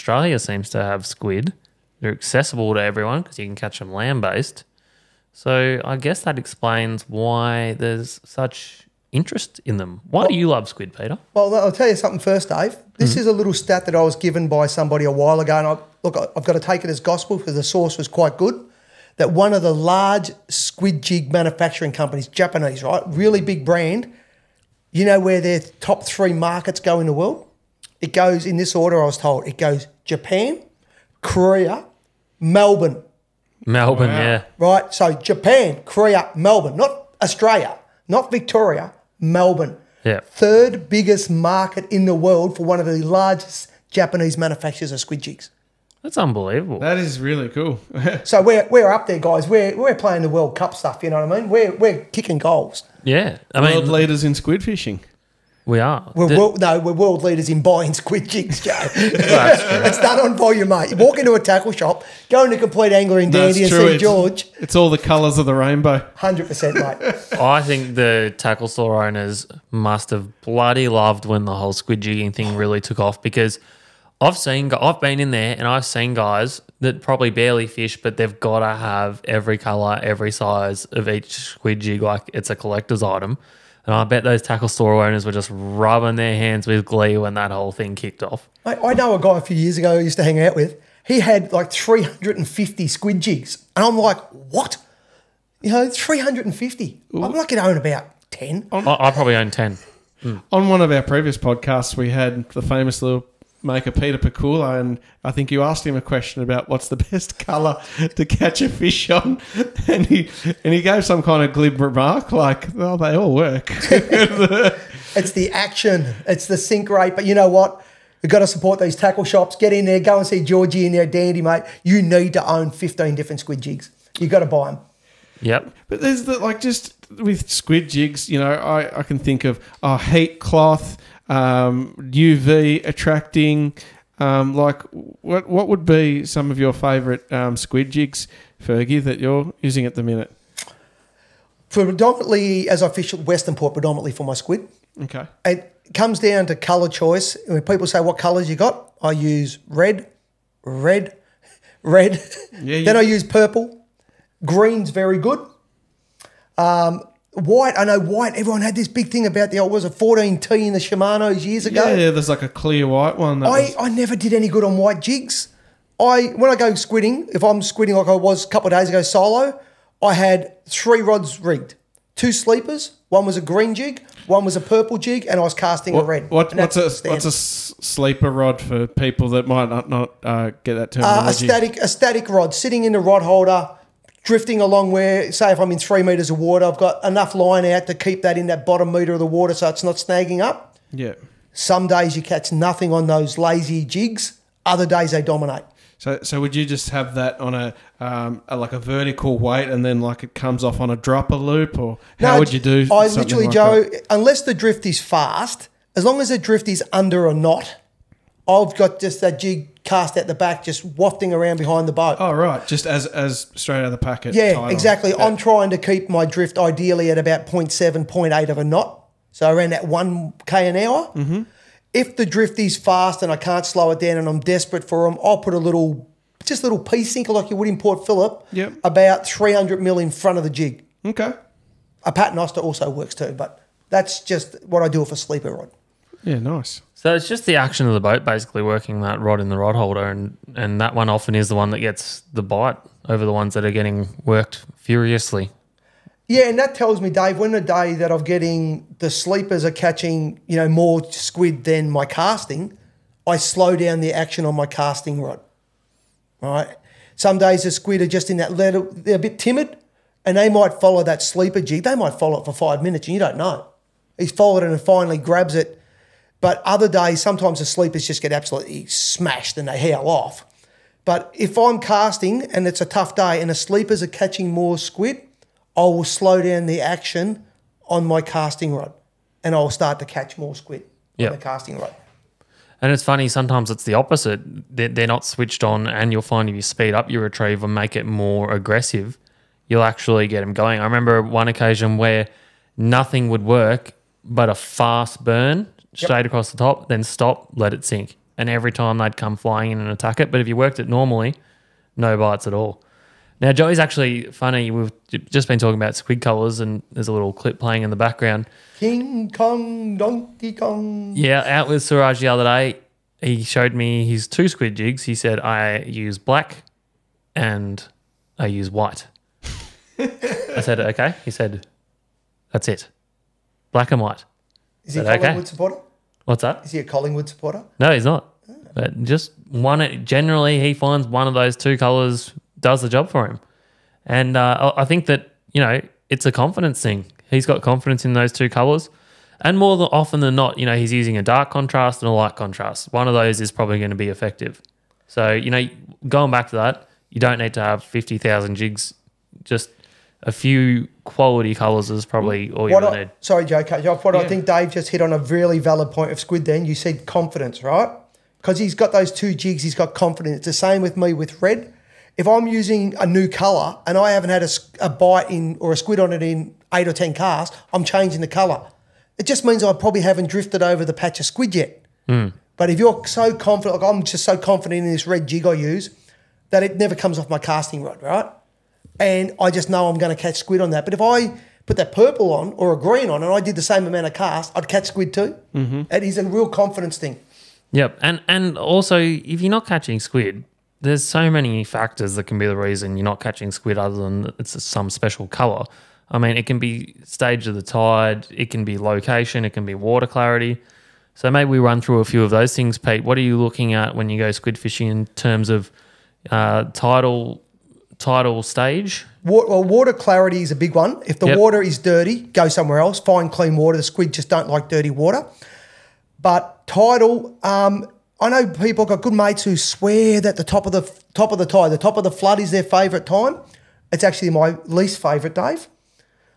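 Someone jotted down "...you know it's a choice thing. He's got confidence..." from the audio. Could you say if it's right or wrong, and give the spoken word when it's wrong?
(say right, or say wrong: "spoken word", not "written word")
wrong: "confidence", not "choice".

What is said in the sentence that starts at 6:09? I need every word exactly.
It just means I probably haven't drifted over the patch of squid yet.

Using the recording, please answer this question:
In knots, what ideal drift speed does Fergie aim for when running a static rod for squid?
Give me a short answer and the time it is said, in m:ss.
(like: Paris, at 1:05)
0.7 to 0.8 knots, at 3:37.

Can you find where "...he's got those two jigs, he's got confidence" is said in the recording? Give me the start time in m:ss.
5:58.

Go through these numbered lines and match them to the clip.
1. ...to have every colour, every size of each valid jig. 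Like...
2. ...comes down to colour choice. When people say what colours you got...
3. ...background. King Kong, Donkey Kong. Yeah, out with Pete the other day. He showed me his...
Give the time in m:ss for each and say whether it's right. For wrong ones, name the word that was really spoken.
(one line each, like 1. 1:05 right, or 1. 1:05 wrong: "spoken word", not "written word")
1. 1:18 wrong: "squid", not "valid"
2. 2:25 right
3. 5:07 wrong: "Suraj", not "Pete".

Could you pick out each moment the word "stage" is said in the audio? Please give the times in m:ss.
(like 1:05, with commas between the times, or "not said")
6:37, 6:48.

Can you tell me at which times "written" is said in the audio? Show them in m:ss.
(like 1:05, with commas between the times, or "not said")
not said.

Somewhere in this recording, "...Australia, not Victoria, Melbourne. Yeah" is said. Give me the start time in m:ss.
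0:37.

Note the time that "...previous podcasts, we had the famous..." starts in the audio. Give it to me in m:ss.
1:41.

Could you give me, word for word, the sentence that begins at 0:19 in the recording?
That one of the large squid jig manufacturing companies, Japanese, right, really big brand.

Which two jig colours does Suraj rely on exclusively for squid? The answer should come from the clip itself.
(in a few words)
black and white.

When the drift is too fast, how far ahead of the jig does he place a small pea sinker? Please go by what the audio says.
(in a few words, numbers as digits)
300 mm.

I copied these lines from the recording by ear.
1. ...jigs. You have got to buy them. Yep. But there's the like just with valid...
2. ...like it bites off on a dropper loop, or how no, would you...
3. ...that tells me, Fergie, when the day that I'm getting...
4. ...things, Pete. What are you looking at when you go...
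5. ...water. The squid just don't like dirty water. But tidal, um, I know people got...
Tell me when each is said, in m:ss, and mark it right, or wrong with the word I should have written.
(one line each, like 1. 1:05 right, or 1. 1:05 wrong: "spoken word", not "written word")
1. 2:03 wrong: "squid", not "valid"
2. 3:19 wrong: "comes", not "bites"
3. 4:06 wrong: "Dave", not "Fergie"
4. 6:42 right
5. 6:53 right.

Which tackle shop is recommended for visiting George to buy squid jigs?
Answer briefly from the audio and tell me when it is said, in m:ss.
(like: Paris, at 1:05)
Complete Angler, at 1:02.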